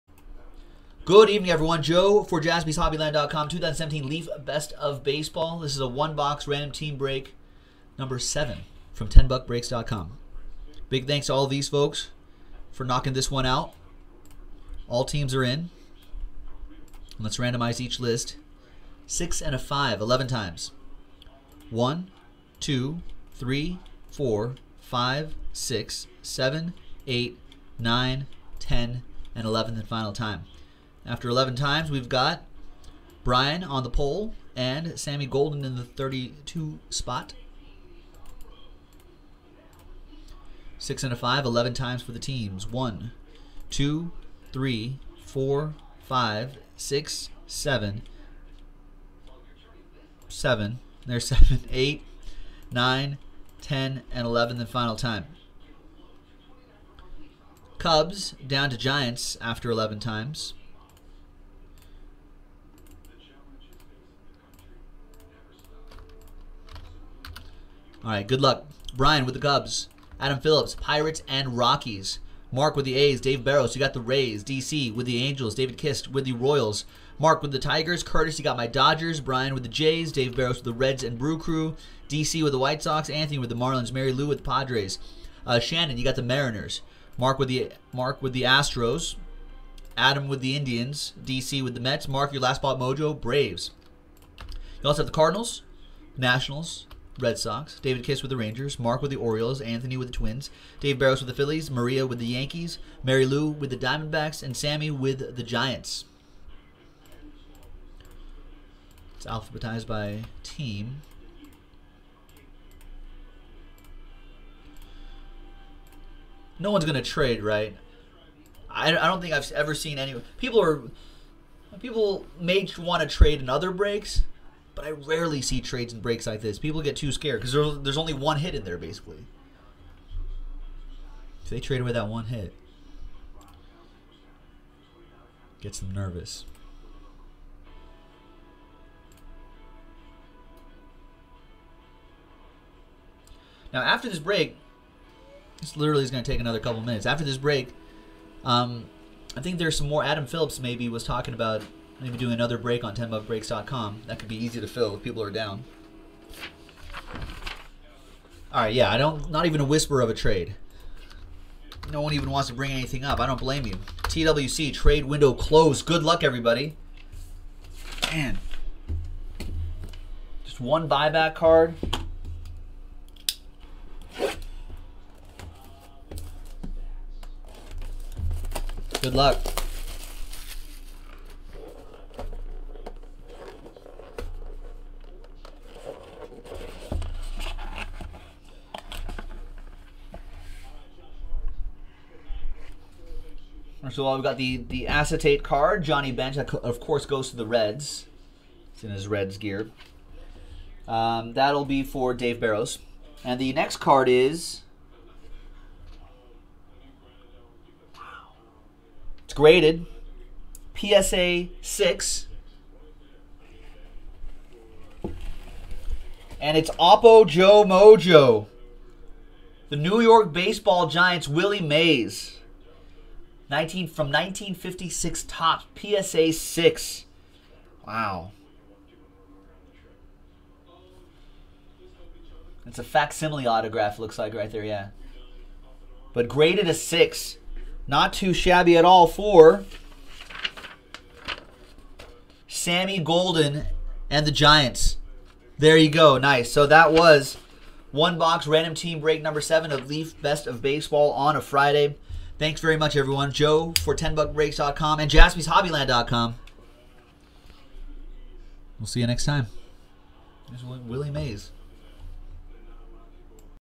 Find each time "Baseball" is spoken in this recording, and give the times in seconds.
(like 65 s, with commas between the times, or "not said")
5 s, 220 s, 250 s.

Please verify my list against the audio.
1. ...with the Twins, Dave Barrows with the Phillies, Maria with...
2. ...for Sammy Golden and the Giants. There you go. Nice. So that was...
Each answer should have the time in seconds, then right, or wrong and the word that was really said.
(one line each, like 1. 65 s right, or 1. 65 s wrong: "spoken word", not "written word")
1. 99 s right
2. 239 s right.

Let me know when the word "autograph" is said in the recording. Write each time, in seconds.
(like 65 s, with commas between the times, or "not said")
233 s.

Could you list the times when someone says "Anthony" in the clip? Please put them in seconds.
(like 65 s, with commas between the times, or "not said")
83 s, 99 s.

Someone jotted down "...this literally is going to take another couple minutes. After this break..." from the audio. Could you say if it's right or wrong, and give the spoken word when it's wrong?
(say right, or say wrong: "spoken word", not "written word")
right.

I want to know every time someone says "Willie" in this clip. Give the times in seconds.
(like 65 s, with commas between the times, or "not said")
221 s, 260 s.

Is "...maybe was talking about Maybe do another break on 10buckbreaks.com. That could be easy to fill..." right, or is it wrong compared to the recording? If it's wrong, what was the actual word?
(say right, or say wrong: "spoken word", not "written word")
right.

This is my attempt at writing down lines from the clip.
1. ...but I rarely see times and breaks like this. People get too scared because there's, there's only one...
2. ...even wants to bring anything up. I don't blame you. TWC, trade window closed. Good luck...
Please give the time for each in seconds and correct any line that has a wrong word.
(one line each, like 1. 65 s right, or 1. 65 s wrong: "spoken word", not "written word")
1. 124 s wrong: "trades", not "times"
2. 162 s right.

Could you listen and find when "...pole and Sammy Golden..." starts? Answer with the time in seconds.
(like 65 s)
33 s.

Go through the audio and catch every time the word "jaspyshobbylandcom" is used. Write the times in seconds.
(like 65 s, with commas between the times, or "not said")
2 s, 255 s.